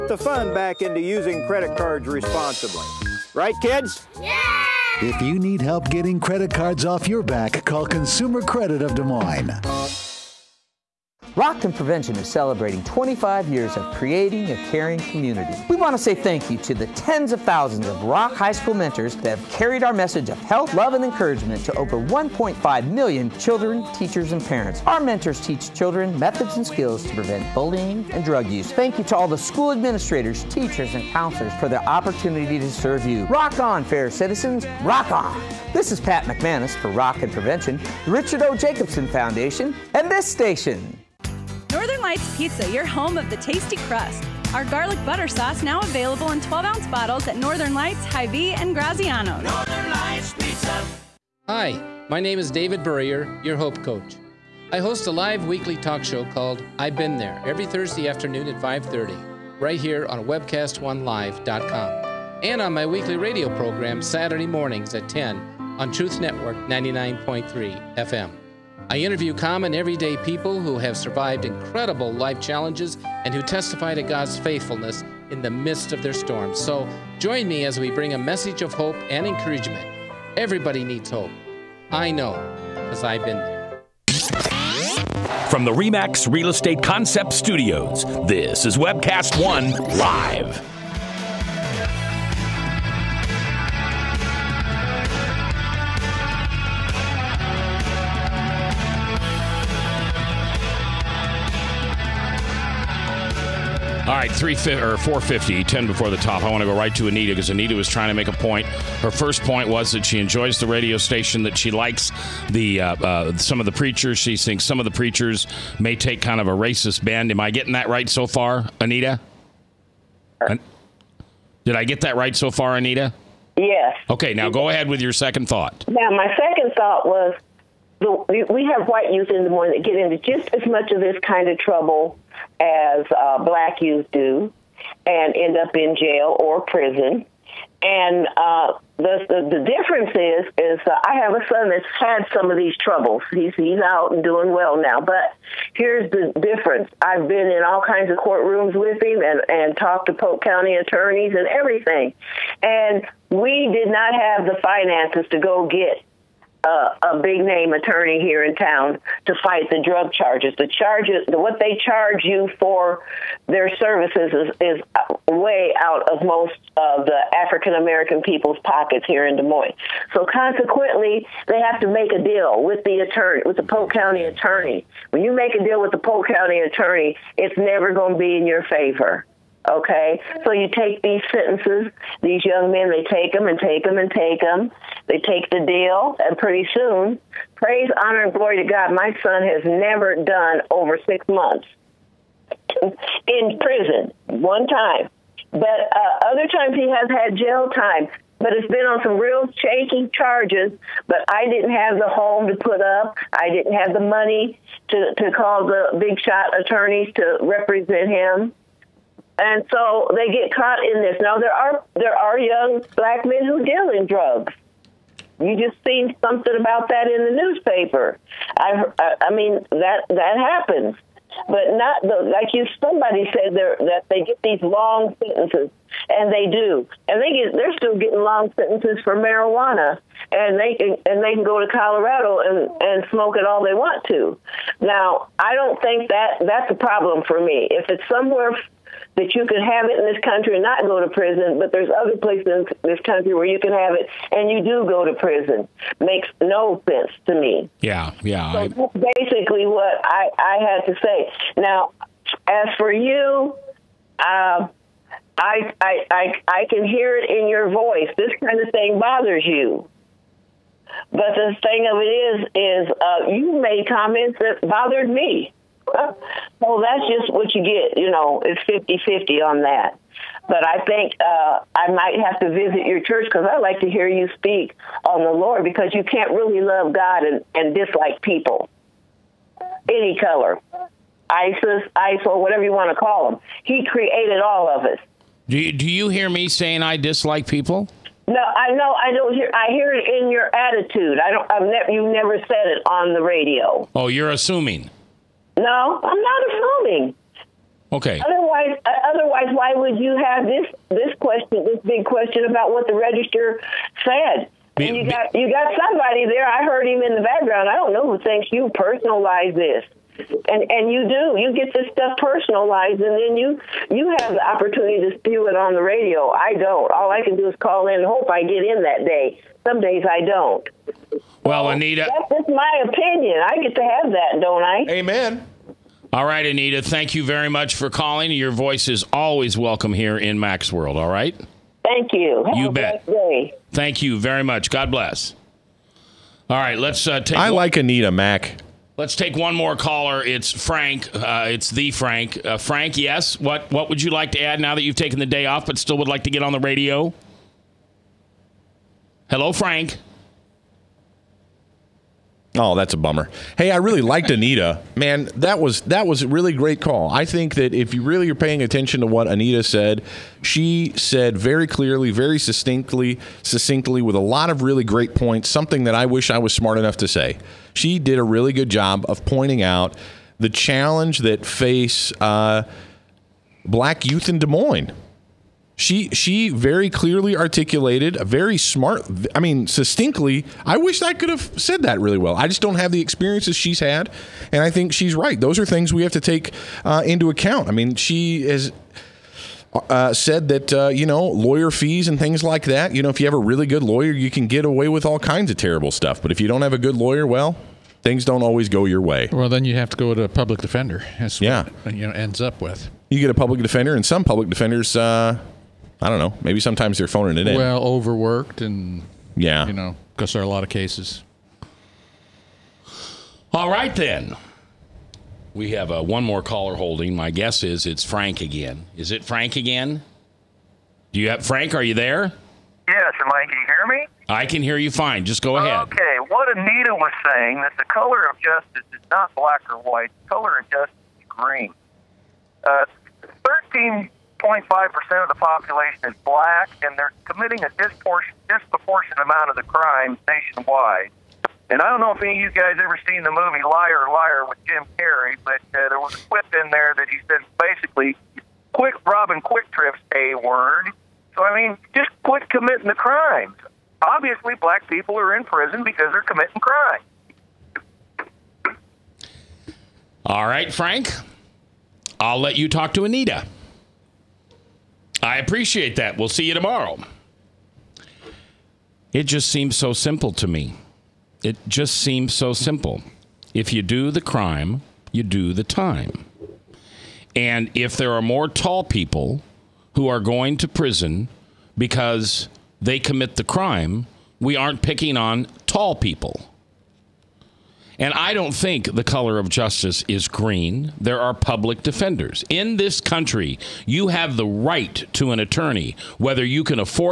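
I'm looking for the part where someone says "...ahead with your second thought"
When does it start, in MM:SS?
02:04.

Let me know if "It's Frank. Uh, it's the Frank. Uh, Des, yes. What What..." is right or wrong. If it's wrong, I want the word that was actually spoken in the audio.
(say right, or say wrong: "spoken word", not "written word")
wrong: "Frank", not "Des".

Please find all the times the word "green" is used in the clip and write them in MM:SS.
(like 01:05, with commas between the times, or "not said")
07:11, 08:10.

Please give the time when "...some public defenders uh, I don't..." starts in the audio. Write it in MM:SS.
06:44.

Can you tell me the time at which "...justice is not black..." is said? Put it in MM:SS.
07:08.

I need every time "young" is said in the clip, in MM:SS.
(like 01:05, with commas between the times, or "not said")
03:02, 03:32.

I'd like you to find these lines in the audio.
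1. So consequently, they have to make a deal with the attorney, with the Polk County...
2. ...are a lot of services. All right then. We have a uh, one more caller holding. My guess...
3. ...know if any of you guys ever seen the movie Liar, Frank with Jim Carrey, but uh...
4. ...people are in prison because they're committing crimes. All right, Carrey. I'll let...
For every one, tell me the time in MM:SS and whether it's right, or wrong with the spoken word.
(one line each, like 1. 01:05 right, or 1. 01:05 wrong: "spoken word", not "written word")
1. 02:50 right
2. 06:50 wrong: "cases", not "services"
3. 07:21 wrong: "Liar", not "Frank"
4. 07:34 wrong: "Frank", not "Carrey".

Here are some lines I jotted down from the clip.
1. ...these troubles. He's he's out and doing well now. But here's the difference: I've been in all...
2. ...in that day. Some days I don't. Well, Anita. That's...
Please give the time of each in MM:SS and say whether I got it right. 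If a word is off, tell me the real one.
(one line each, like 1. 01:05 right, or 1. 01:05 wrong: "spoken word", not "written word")
1. 02:22 right
2. 05:18 right.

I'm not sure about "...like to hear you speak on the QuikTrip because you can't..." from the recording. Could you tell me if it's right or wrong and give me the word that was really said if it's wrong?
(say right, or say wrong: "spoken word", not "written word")
wrong: "Lord", not "QuikTrip".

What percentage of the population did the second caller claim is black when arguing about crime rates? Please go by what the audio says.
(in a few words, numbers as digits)
6.5%.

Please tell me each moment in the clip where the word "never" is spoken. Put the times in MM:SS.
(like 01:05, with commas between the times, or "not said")
02:57, 03:09, 04:52.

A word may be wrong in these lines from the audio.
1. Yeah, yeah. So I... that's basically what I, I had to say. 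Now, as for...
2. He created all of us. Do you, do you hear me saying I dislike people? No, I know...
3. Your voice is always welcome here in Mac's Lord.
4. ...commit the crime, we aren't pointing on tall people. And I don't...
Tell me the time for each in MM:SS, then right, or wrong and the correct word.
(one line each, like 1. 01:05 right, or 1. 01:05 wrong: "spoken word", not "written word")
1. 04:07 right
2. 04:43 right
3. 05:28 wrong: "World", not "Lord"
4. 08:02 wrong: "picking", not "pointing".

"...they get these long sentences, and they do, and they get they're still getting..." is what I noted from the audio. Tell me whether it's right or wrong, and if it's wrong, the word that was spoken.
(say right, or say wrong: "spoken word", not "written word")
right.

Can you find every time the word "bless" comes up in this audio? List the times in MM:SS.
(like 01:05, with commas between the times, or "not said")
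05:34.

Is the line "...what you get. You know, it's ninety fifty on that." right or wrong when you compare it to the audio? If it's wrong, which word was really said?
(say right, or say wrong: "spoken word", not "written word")
wrong: "fifty", not "ninety".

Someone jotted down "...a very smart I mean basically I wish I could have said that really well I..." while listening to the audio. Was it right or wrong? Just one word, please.
wrong.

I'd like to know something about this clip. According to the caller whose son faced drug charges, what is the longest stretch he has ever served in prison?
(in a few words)
6 months.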